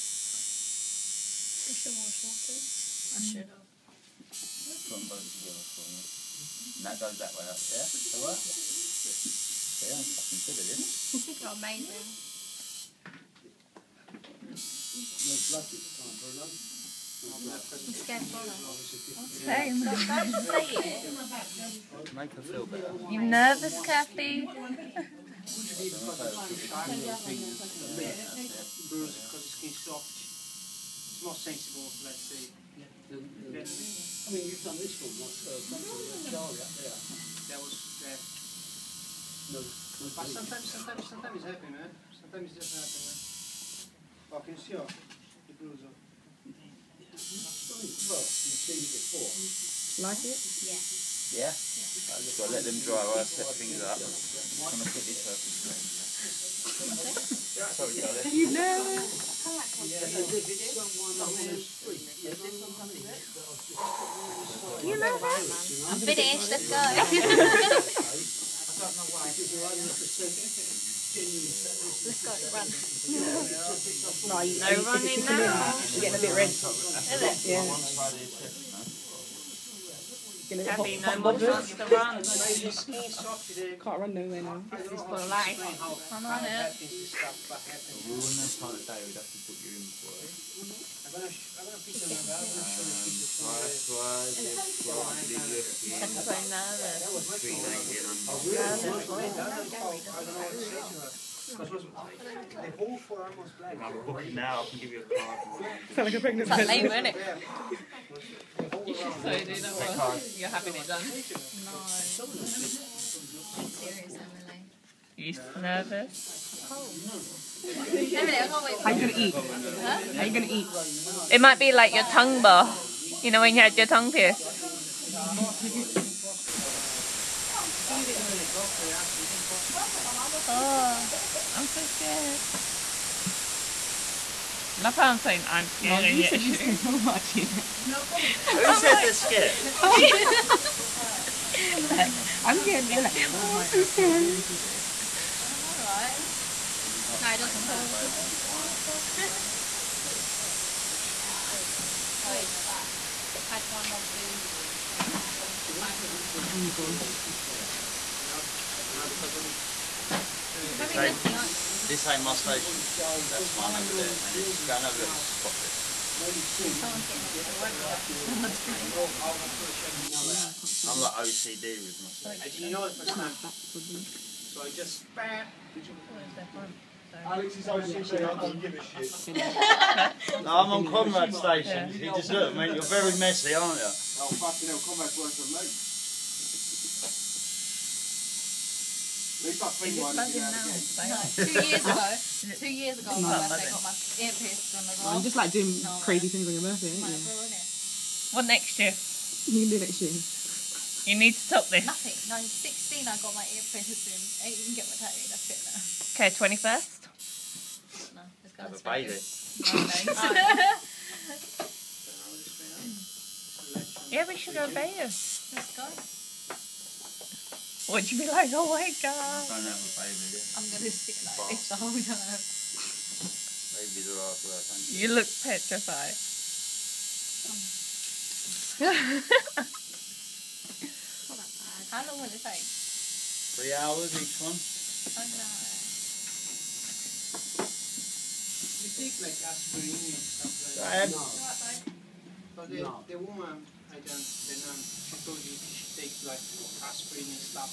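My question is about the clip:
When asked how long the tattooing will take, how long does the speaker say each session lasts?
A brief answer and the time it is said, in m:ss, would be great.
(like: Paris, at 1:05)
3 hours, at 3:52.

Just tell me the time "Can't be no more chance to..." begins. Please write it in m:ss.
1:20.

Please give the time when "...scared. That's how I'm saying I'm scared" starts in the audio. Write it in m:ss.
2:11.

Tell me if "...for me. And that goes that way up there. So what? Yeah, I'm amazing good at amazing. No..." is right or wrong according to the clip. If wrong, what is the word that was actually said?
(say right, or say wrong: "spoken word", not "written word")
wrong: "fucking", not "amazing".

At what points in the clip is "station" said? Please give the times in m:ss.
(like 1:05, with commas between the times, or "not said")
2:42, 3:01.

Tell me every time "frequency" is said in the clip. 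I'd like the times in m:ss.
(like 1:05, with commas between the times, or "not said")
not said.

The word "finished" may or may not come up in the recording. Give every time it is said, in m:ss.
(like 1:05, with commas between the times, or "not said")
1:05, 2:48.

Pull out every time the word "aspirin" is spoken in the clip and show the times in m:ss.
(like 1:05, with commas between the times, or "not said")
3:59, 4:06.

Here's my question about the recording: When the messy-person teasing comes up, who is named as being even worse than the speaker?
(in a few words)
Conrad.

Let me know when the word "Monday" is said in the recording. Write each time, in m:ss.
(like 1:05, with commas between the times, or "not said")
not said.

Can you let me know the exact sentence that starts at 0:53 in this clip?
I'm gonna put this over the screen.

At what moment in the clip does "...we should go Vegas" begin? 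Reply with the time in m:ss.
3:34.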